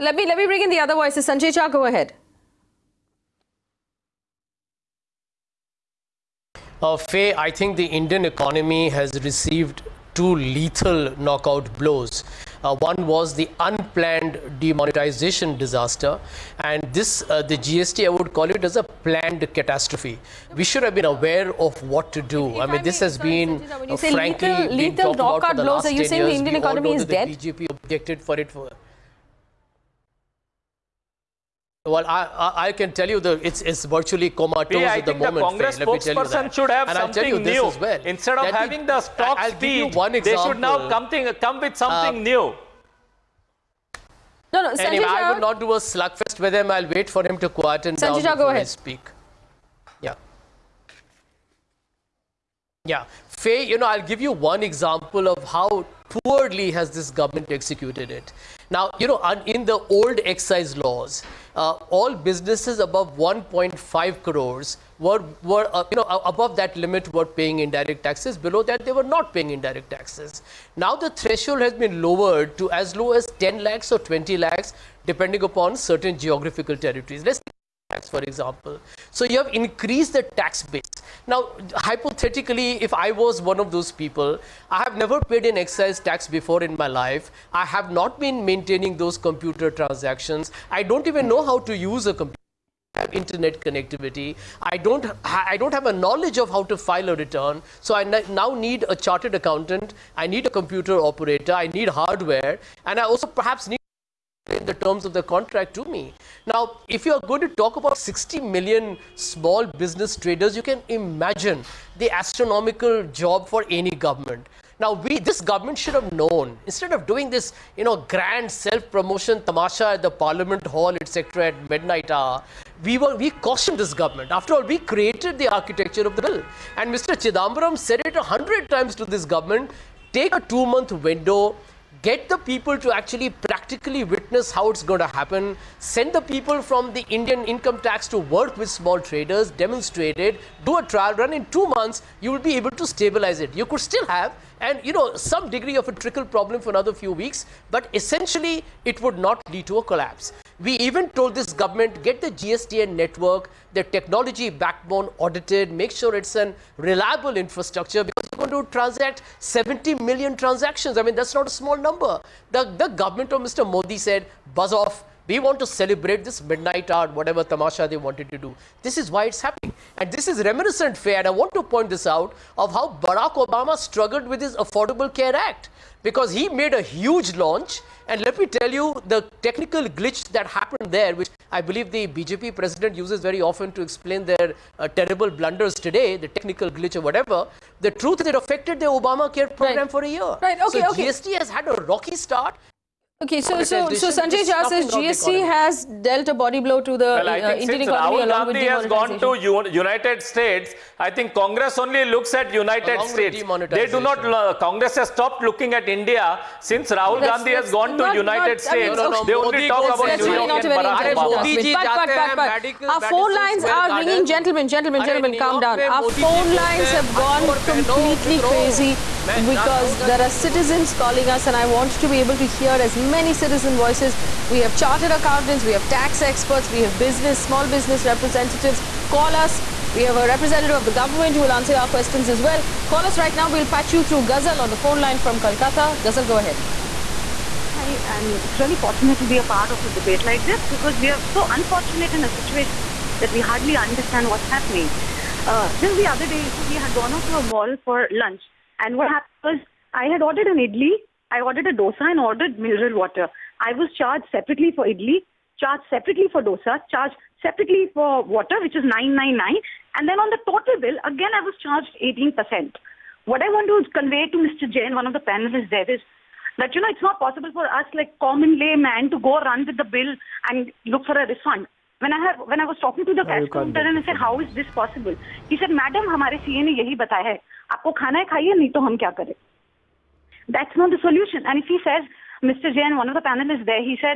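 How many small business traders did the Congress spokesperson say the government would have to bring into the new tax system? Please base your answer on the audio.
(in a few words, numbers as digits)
60 million.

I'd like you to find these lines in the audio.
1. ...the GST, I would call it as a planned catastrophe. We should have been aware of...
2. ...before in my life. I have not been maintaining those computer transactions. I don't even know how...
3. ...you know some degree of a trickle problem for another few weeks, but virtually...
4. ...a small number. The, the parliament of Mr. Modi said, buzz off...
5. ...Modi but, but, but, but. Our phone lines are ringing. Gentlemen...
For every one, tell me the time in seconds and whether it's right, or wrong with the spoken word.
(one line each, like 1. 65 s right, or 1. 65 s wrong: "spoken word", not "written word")
1. 17 s right
2. 86 s right
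3. 144 s wrong: "essentially", not "virtually"
4. 161 s wrong: "government", not "parliament"
5. 211 s right.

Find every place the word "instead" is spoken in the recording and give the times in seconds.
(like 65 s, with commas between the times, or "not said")
38 s, 116 s.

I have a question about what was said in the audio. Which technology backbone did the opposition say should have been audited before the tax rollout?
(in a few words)
GSTN network.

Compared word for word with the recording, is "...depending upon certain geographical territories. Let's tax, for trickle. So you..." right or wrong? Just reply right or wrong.
wrong.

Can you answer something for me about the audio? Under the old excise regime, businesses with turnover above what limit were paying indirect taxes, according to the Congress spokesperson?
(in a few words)
1.5 crores.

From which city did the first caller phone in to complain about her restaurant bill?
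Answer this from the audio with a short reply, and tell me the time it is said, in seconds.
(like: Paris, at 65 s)
Kolkata, at 235 s.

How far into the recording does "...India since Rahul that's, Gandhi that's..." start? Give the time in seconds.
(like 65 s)
205 s.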